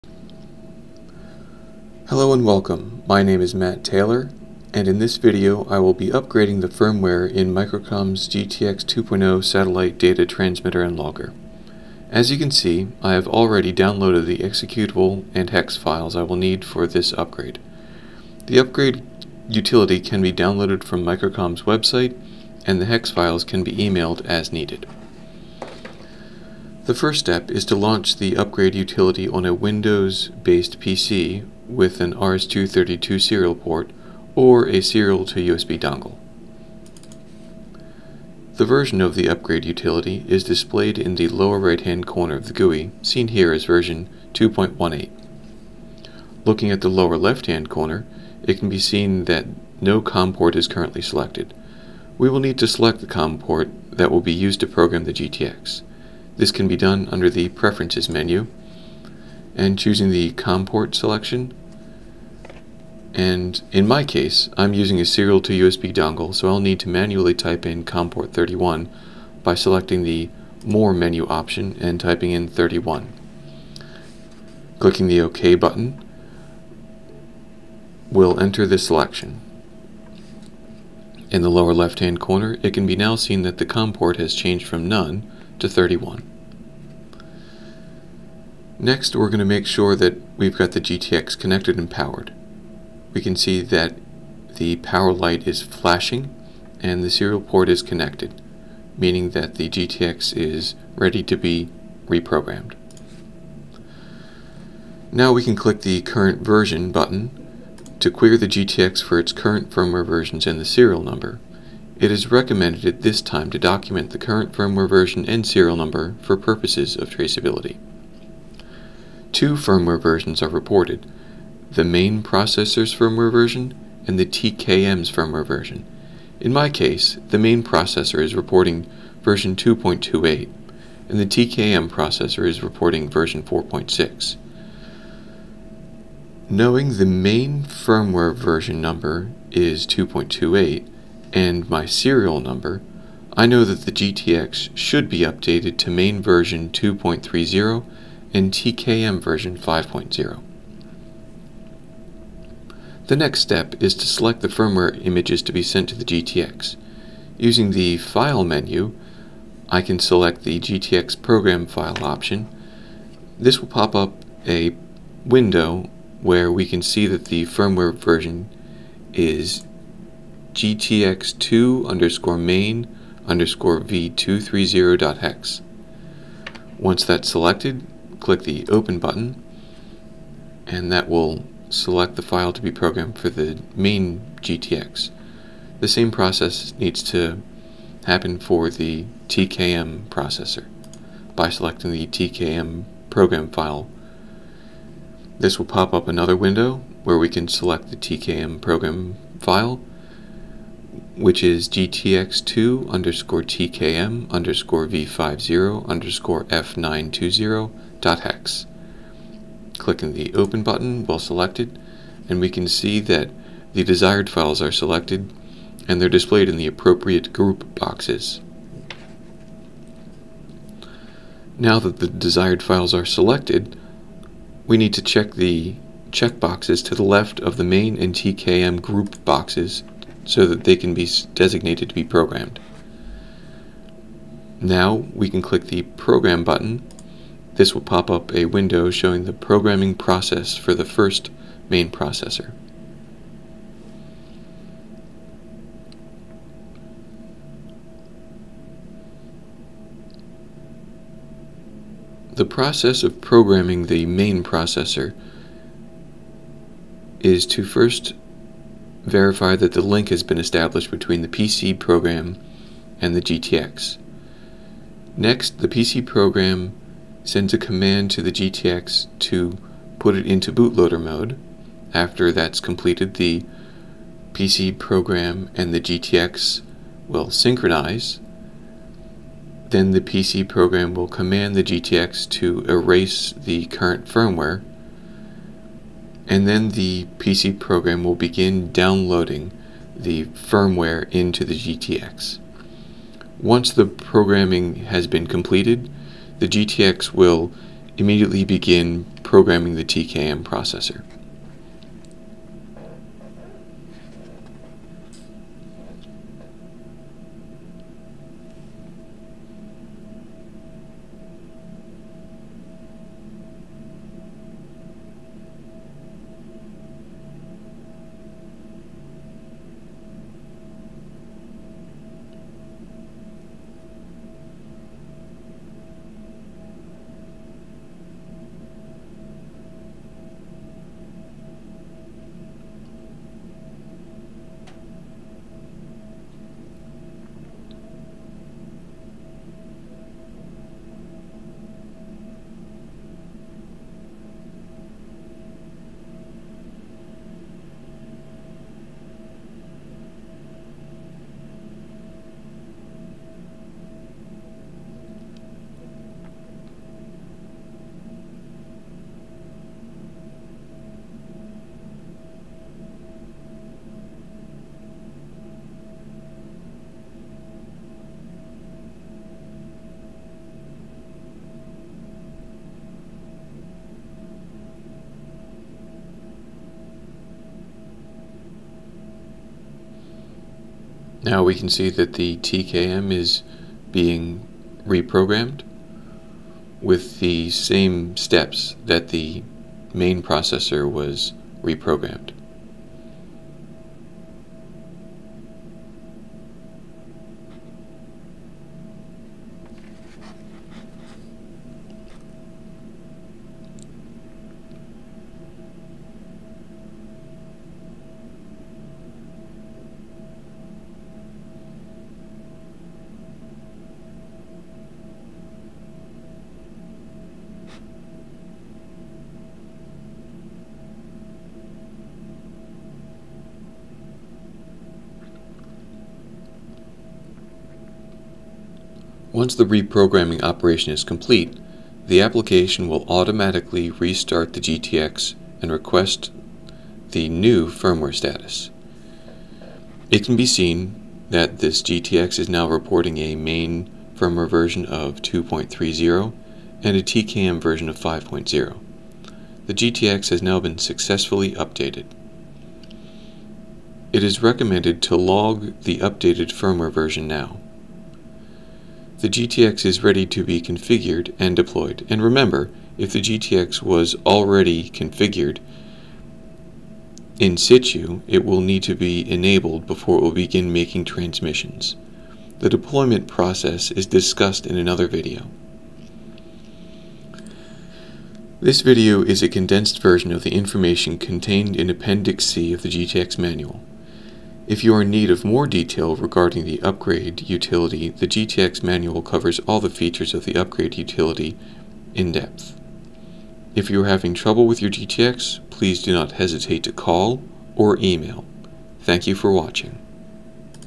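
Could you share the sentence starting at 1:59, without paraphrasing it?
Two firmware versions are reported, the main processor's firmware version and the TKM's firmware version.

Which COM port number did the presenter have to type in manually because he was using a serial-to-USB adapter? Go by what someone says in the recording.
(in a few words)
31.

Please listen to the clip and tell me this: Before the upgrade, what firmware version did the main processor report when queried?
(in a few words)
2.28.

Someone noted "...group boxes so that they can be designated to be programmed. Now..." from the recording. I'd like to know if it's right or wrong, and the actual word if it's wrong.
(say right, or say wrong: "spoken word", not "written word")
right.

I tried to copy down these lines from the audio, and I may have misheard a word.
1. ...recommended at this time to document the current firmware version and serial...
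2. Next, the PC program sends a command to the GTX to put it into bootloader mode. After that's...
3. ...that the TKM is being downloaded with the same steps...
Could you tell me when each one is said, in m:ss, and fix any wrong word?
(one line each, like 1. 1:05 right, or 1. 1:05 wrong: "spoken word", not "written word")
1. 1:52 right
2. 4:25 right
3. 6:21 wrong: "reprogrammed", not "downloaded".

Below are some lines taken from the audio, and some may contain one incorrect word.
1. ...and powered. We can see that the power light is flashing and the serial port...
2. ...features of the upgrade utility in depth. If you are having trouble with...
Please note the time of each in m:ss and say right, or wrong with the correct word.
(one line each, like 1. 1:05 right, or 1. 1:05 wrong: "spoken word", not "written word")
1. 1:31 right
2. 8:09 right.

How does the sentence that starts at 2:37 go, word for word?
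Using the File menu, I can select the GTX Program File option.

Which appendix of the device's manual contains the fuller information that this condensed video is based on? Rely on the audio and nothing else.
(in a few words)
Appendix C.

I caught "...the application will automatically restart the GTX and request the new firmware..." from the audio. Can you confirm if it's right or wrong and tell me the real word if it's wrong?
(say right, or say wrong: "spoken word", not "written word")
right.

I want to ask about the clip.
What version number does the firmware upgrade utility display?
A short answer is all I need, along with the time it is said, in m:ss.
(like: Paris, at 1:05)
2.18, at 0:43.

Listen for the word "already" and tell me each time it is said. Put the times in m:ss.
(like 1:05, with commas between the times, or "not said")
0:13, 7:44.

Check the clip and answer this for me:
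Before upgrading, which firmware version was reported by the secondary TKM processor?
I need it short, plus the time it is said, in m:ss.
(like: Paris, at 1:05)
4.6, at 2:13.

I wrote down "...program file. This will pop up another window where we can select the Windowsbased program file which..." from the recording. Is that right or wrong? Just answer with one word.
wrong.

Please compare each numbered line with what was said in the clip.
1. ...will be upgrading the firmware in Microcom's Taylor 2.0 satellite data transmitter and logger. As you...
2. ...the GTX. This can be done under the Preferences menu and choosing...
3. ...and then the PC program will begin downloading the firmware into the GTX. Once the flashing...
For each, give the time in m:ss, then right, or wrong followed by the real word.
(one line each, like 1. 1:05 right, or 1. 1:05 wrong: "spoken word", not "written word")
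1. 0:05 wrong: "GTX", not "Taylor"
2. 0:55 right
3. 4:46 wrong: "programming", not "flashing".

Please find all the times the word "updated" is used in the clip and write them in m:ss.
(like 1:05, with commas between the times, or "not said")
2:25, 7:31, 7:35.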